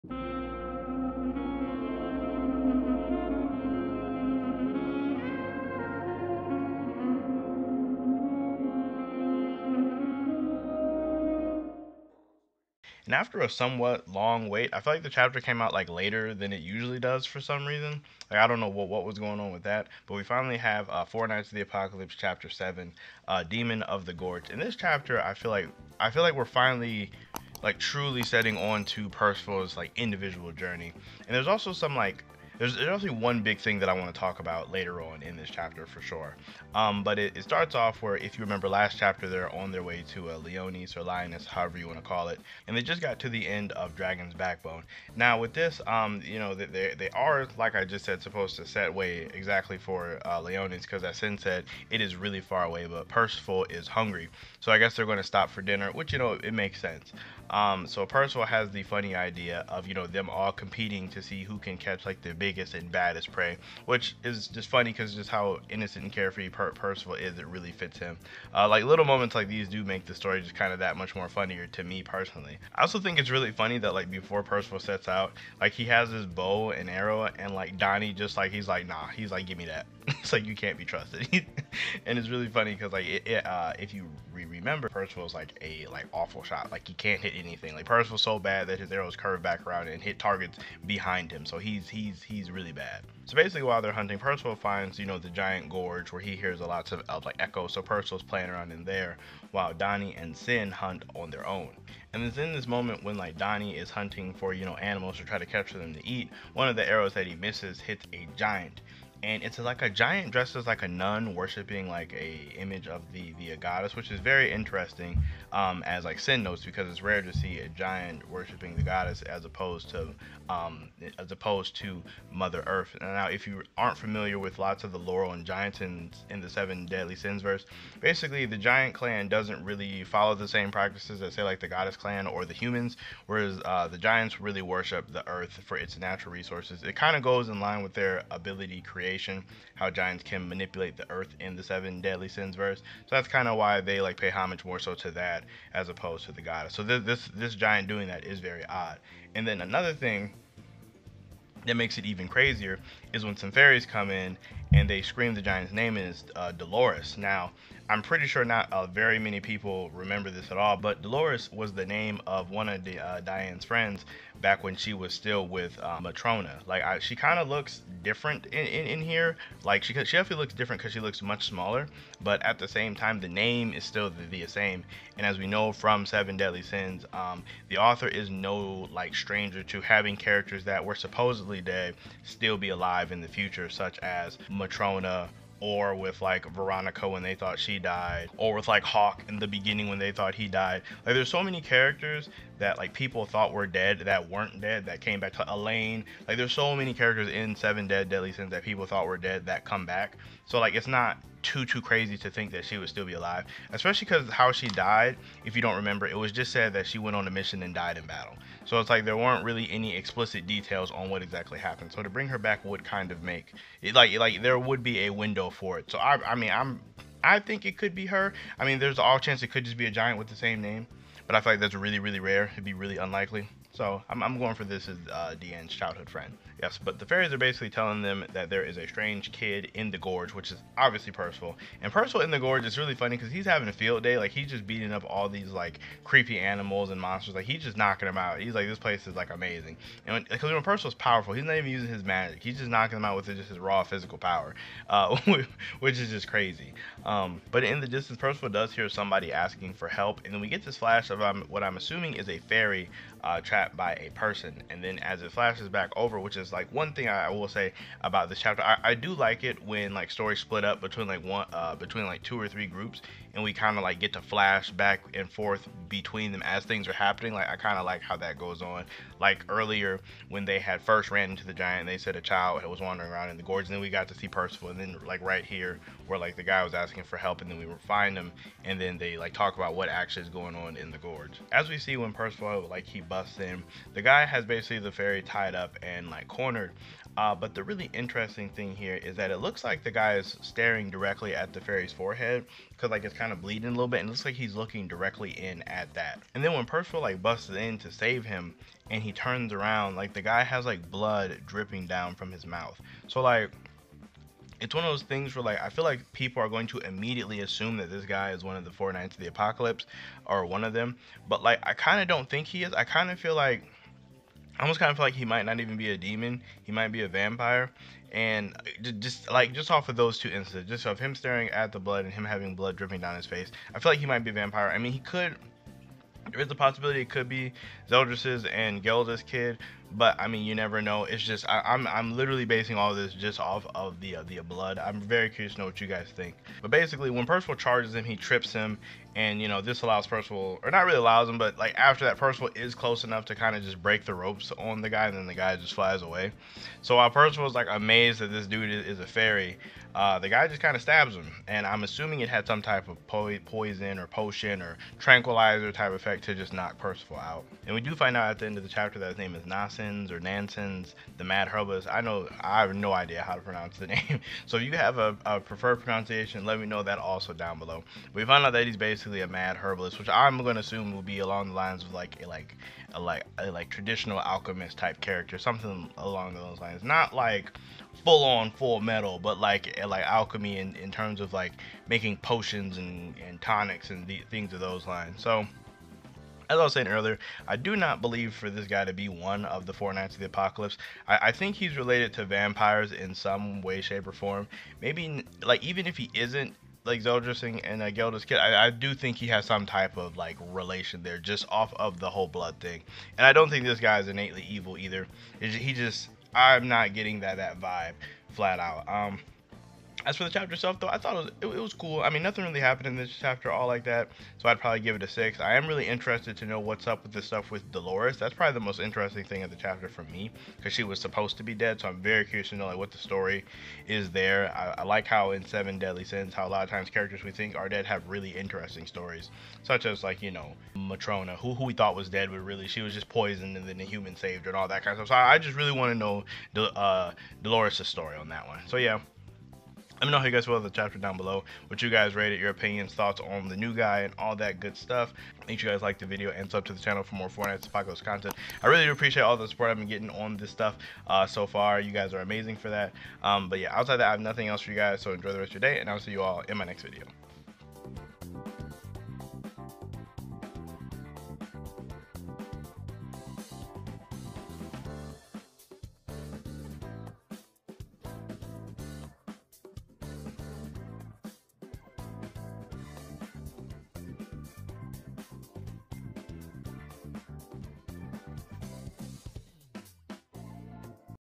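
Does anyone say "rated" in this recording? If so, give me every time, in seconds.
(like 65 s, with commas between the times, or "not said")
442 s.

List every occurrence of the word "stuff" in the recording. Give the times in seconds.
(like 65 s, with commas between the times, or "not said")
417 s, 435 s, 444 s, 450 s.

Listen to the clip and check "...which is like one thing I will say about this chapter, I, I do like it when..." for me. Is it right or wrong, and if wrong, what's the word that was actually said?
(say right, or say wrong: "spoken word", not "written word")
right.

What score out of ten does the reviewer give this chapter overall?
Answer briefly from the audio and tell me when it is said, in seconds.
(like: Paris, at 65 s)
6, at 415 s.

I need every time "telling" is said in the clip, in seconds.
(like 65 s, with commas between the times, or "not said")
227 s.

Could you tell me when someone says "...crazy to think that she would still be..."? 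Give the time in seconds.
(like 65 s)
201 s.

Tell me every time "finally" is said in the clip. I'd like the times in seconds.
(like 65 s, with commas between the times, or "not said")
20 s, 26 s.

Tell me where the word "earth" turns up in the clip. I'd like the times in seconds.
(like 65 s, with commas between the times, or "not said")
122 s, 135 s, 141 s.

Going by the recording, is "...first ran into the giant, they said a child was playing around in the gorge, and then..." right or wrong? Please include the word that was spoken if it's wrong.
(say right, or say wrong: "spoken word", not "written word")
wrong: "wandering", not "playing".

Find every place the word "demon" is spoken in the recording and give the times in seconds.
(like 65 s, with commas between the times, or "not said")
23 s, 315 s.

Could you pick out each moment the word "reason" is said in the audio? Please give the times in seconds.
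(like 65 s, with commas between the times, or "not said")
17 s.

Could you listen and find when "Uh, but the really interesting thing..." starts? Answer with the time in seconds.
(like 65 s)
287 s.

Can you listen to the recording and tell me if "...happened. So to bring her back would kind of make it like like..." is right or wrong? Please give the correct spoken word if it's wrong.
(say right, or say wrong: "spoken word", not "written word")
right.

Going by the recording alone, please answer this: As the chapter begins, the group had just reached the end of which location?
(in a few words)
Dragon's Backbone.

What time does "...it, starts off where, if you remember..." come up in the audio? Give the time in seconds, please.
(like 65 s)
37 s.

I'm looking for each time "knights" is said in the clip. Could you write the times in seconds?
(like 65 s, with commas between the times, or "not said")
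21 s, 308 s, 389 s.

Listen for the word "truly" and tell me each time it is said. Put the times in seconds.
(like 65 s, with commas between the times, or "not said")
27 s.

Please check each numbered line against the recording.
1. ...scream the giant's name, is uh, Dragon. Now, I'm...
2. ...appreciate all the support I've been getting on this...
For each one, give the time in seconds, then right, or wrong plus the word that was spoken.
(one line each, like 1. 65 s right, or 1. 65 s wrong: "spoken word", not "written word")
1. 155 s wrong: "Dolores", not "Dragon"
2. 448 s right.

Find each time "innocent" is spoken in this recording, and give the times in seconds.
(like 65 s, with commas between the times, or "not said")
65 s.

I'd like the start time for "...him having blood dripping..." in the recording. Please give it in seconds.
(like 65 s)
322 s.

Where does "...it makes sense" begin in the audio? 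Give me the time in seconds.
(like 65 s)
56 s.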